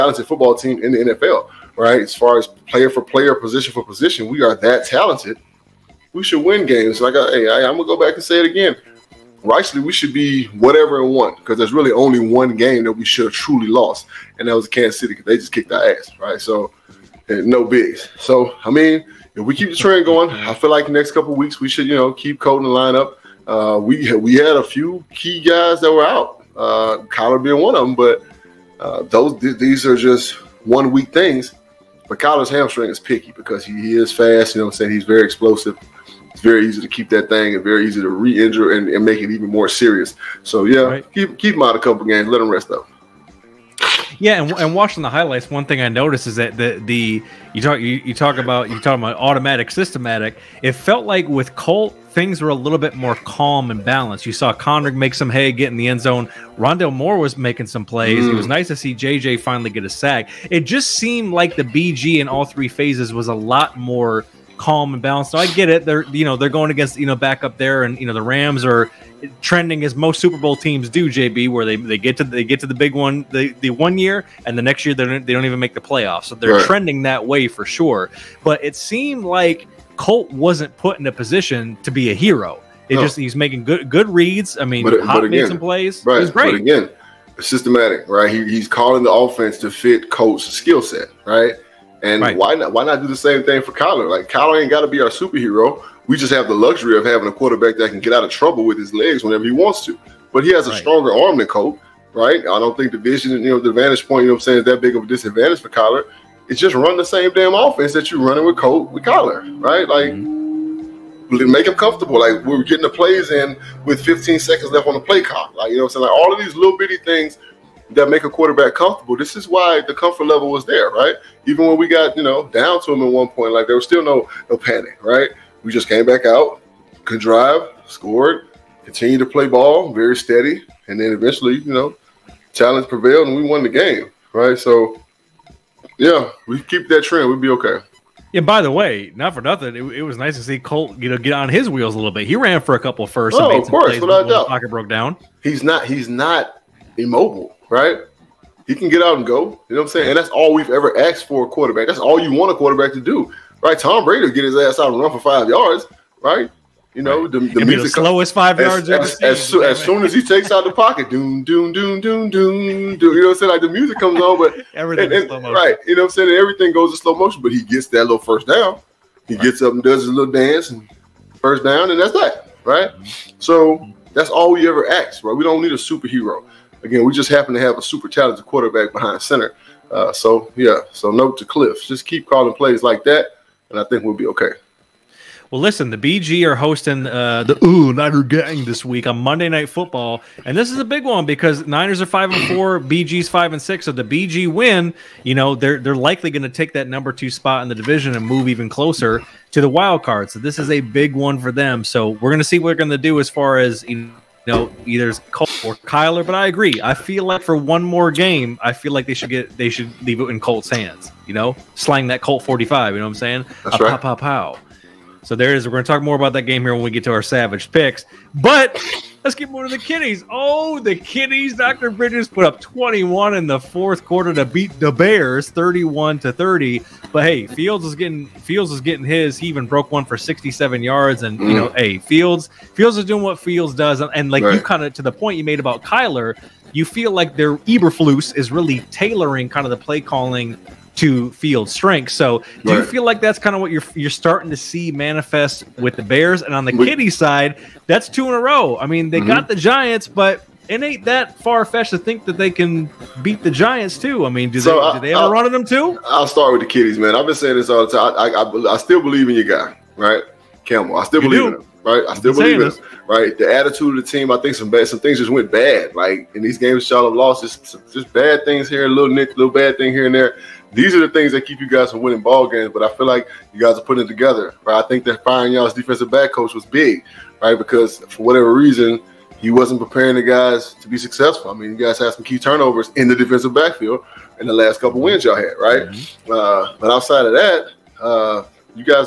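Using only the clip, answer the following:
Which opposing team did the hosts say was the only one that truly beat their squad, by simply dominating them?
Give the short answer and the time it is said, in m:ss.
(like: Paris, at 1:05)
Kansas City, at 0:14.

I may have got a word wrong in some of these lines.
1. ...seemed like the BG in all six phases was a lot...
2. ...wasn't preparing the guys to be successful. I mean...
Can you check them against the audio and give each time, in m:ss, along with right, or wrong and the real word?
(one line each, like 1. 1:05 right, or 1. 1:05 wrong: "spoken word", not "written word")
1. 1:00 wrong: "three", not "six"
2. 4:39 right.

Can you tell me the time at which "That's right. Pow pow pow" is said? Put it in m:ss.
3:33.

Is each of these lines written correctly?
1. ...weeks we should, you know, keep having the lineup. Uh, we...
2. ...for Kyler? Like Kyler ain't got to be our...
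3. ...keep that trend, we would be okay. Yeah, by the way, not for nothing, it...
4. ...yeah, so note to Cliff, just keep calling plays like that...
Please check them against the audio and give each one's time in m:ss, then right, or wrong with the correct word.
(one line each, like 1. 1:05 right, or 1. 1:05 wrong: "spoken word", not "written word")
1. 0:21 wrong: "coding", not "having"
2. 1:33 right
3. 2:16 right
4. 3:00 right.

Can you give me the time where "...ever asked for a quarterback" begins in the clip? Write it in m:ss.
2:30.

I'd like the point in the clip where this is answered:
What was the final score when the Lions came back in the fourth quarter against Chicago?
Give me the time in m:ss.
3:45.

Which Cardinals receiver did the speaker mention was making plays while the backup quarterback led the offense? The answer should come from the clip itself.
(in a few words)
Rondale Moore.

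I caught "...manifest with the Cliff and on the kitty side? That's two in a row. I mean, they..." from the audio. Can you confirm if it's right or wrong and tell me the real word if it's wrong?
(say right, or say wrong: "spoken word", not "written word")
wrong: "Bears", not "Cliff".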